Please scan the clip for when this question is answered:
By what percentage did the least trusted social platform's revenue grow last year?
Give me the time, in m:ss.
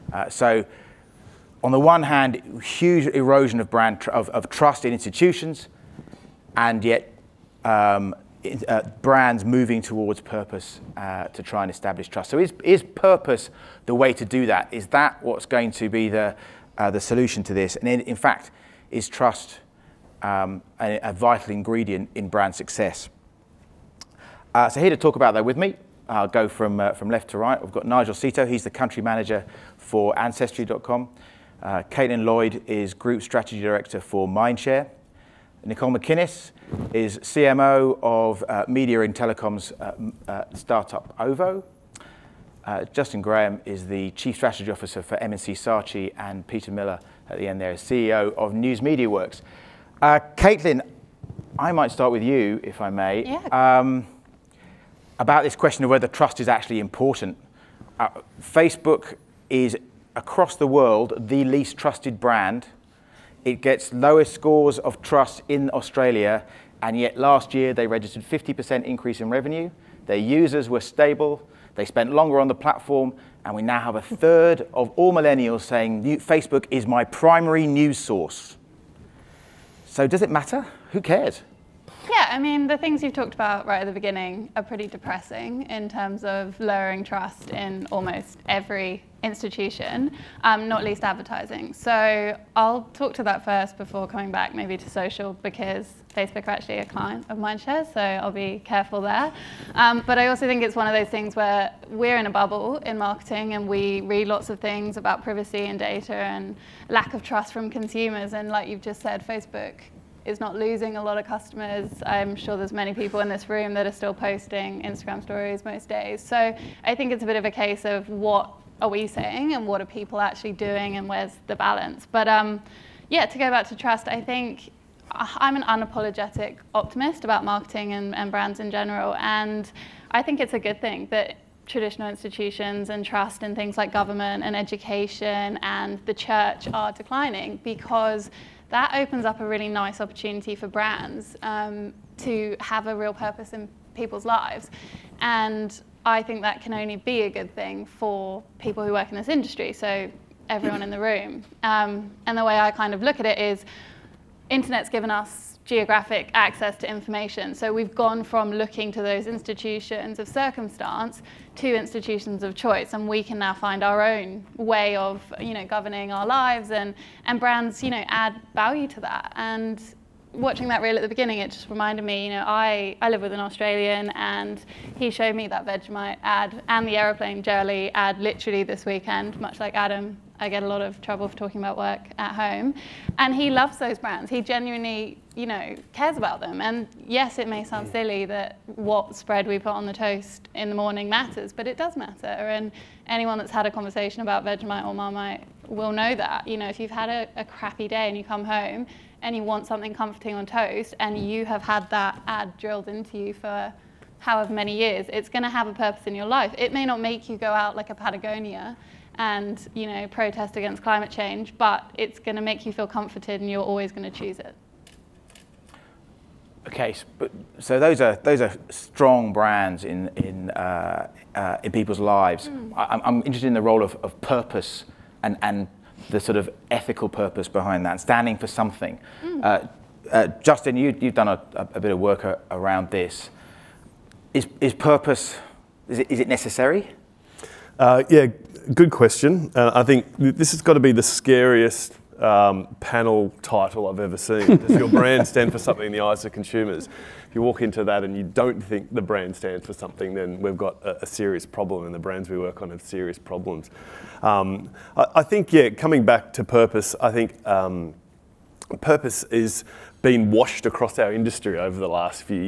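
1:08.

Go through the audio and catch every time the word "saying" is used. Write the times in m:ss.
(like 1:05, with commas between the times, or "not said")
1:15, 1:59.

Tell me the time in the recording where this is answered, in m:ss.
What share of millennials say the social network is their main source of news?
1:13.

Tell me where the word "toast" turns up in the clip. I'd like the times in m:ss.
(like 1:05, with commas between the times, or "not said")
3:09, 3:20.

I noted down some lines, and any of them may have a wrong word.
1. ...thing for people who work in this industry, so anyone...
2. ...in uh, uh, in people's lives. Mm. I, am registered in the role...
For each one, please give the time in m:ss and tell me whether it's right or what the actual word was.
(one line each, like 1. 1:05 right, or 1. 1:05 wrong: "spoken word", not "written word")
1. 2:27 wrong: "everyone", not "anyone"
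2. 3:40 wrong: "interested", not "registered".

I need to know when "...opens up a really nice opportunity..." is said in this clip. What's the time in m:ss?
2:18.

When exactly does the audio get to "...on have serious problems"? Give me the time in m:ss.
4:12.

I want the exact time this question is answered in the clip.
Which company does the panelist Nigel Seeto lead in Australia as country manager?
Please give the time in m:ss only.
0:30.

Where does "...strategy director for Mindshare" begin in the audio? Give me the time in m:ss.
0:33.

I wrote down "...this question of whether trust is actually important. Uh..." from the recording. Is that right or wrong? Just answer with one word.
right.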